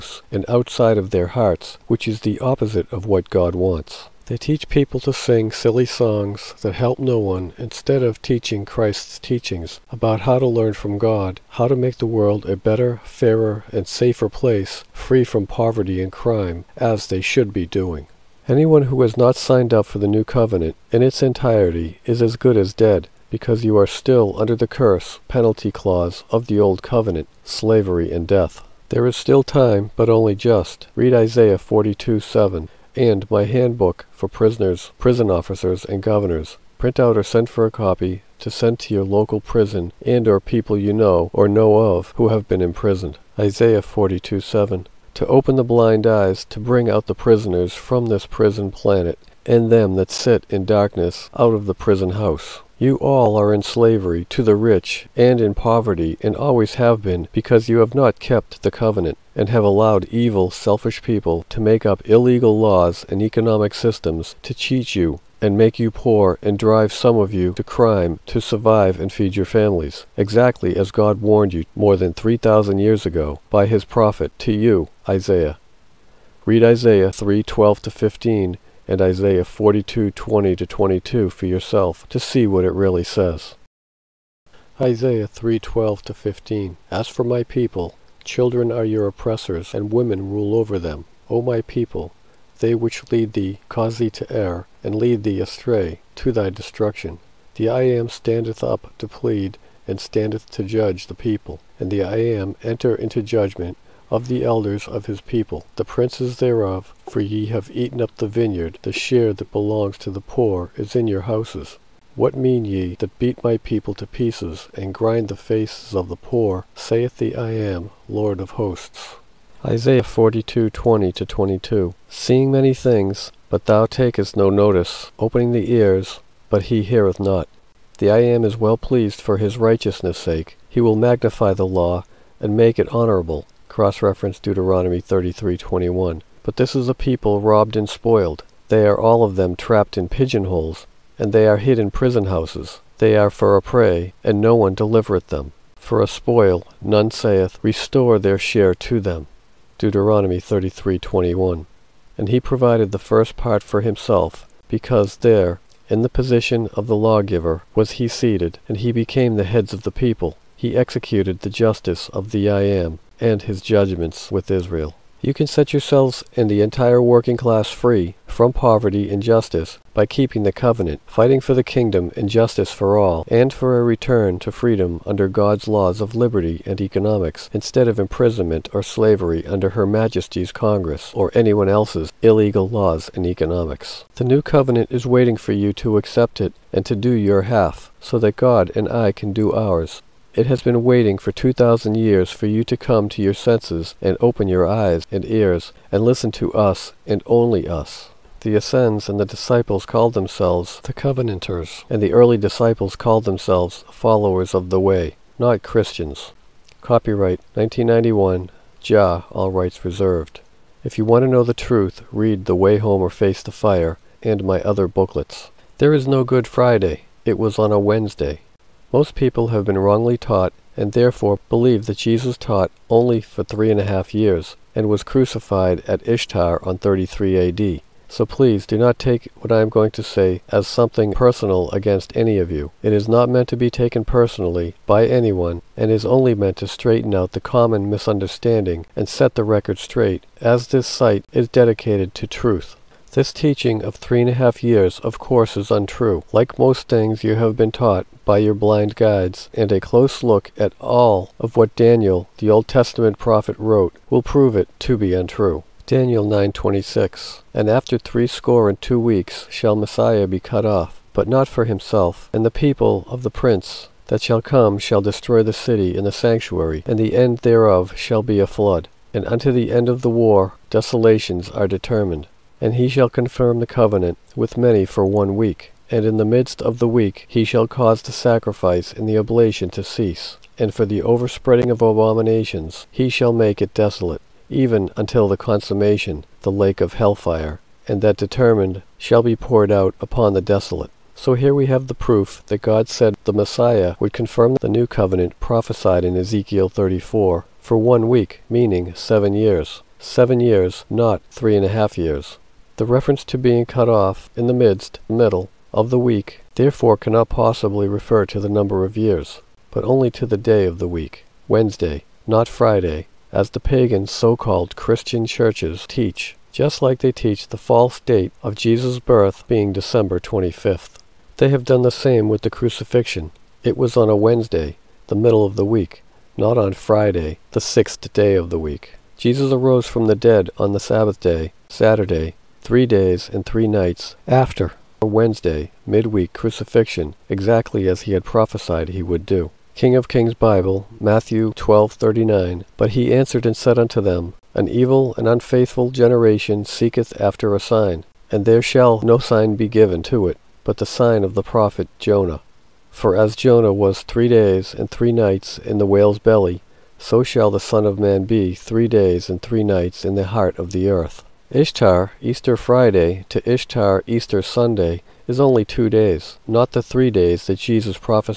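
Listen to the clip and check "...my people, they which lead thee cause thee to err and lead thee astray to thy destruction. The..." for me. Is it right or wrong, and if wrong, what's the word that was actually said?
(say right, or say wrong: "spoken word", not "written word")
right.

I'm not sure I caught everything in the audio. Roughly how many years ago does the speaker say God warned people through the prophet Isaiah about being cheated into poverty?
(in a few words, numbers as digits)
3,000.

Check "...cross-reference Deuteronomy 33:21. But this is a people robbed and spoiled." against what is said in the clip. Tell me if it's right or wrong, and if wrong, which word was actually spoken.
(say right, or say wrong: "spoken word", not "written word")
right.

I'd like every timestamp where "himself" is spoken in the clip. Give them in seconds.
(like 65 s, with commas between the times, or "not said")
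153 s, 261 s.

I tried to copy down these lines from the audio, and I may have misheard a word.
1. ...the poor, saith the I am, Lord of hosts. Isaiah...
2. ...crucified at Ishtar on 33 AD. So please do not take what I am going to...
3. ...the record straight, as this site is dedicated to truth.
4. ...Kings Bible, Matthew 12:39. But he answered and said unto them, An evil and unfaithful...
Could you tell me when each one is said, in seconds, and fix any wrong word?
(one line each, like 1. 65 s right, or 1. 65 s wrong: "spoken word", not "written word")
1. 116 s right
2. 225 s right
3. 239 s right
4. 340 s right.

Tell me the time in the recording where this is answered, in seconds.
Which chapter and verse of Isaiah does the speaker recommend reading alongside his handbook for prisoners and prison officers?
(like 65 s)
31 s.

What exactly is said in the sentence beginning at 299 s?
Seven years, not three and a half years.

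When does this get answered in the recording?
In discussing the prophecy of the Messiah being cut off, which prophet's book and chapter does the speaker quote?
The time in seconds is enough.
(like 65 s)
255 s.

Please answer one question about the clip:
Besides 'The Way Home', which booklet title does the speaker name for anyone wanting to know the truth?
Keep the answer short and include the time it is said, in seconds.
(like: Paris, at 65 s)
Face the Fire, at 213 s.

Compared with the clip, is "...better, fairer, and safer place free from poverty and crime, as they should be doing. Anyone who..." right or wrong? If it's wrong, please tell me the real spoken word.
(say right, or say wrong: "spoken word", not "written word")
right.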